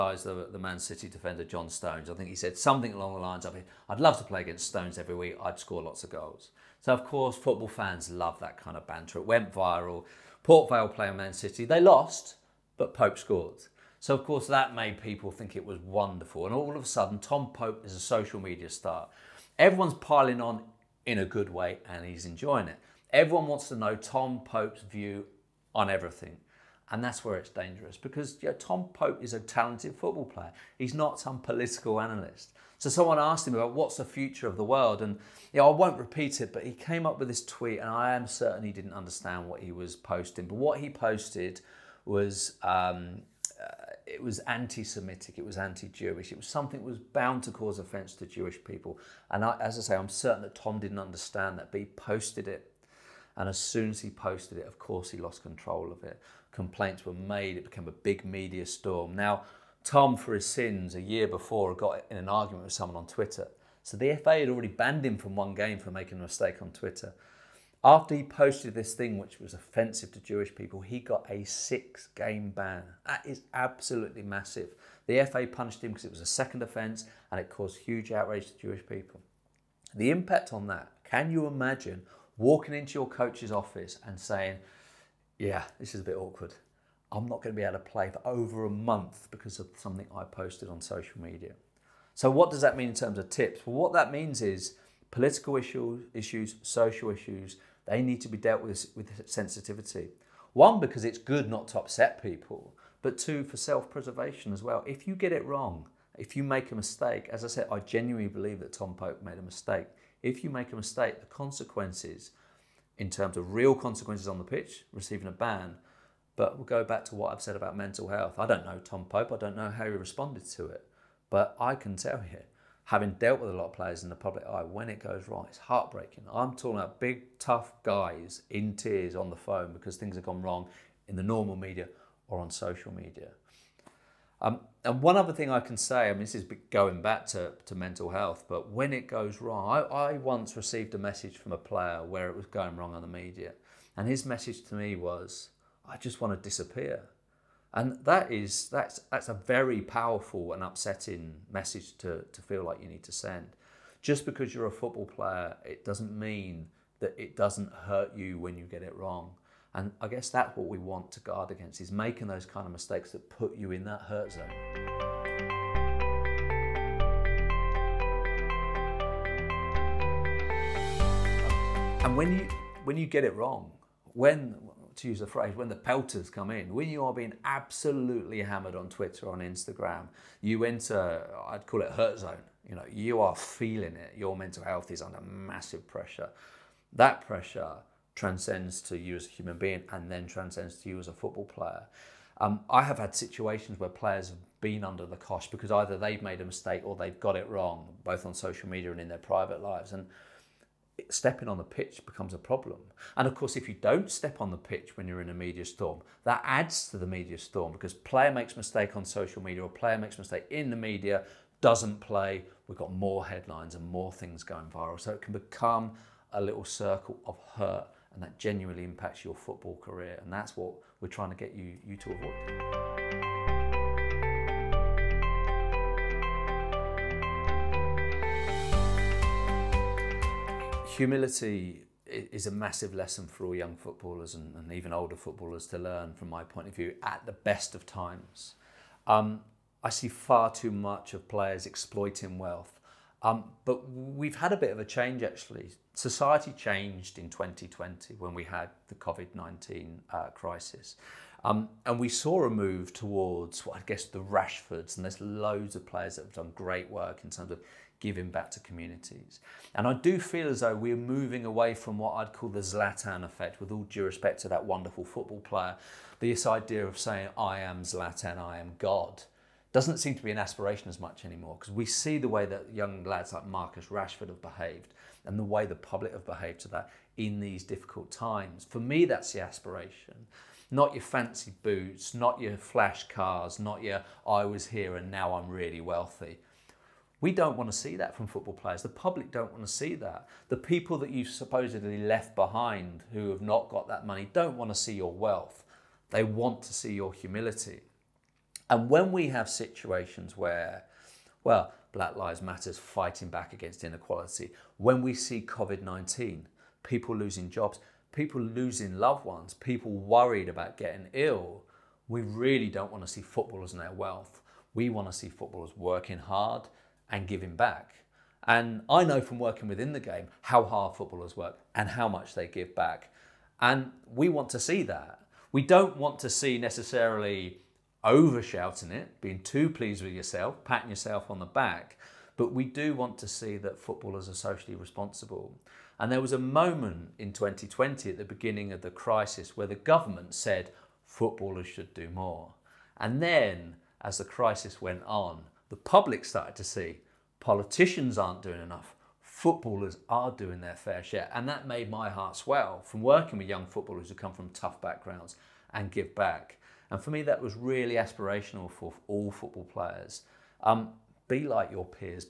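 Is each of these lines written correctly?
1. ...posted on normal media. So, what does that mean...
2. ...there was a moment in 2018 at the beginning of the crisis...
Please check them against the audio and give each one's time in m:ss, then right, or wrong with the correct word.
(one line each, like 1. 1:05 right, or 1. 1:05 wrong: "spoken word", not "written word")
1. 1:30 wrong: "social", not "normal"
2. 5:36 wrong: "2020", not "2018".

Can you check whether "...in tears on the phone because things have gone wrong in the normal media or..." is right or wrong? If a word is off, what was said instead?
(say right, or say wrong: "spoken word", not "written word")
right.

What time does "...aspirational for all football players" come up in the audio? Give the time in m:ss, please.
5:57.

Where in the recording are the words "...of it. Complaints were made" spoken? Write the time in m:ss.
0:55.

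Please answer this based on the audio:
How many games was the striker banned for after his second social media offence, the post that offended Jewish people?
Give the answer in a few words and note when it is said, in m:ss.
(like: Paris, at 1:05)
6, at 1:11.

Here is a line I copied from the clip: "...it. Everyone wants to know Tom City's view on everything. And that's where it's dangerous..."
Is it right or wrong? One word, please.
wrong.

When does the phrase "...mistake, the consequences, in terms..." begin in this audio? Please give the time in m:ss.
1:50.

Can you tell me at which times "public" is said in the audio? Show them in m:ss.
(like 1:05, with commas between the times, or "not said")
2:04, 4:35, 4:48, 5:45.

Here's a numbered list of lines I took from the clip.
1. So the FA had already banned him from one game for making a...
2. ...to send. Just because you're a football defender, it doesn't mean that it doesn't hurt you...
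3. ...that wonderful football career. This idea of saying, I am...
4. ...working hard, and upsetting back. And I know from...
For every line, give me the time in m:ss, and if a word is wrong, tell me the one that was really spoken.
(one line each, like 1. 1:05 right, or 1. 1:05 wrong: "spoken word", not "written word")
1. 1:03 right
2. 2:33 wrong: "player", not "defender"
3. 4:24 wrong: "player", not "career"
4. 5:15 wrong: "giving", not "upsetting".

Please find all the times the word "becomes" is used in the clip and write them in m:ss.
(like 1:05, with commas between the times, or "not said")
3:22, 3:35.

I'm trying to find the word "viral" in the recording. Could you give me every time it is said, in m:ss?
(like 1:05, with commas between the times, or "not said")
0:09, 3:34.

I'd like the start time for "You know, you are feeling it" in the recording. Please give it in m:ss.
3:02.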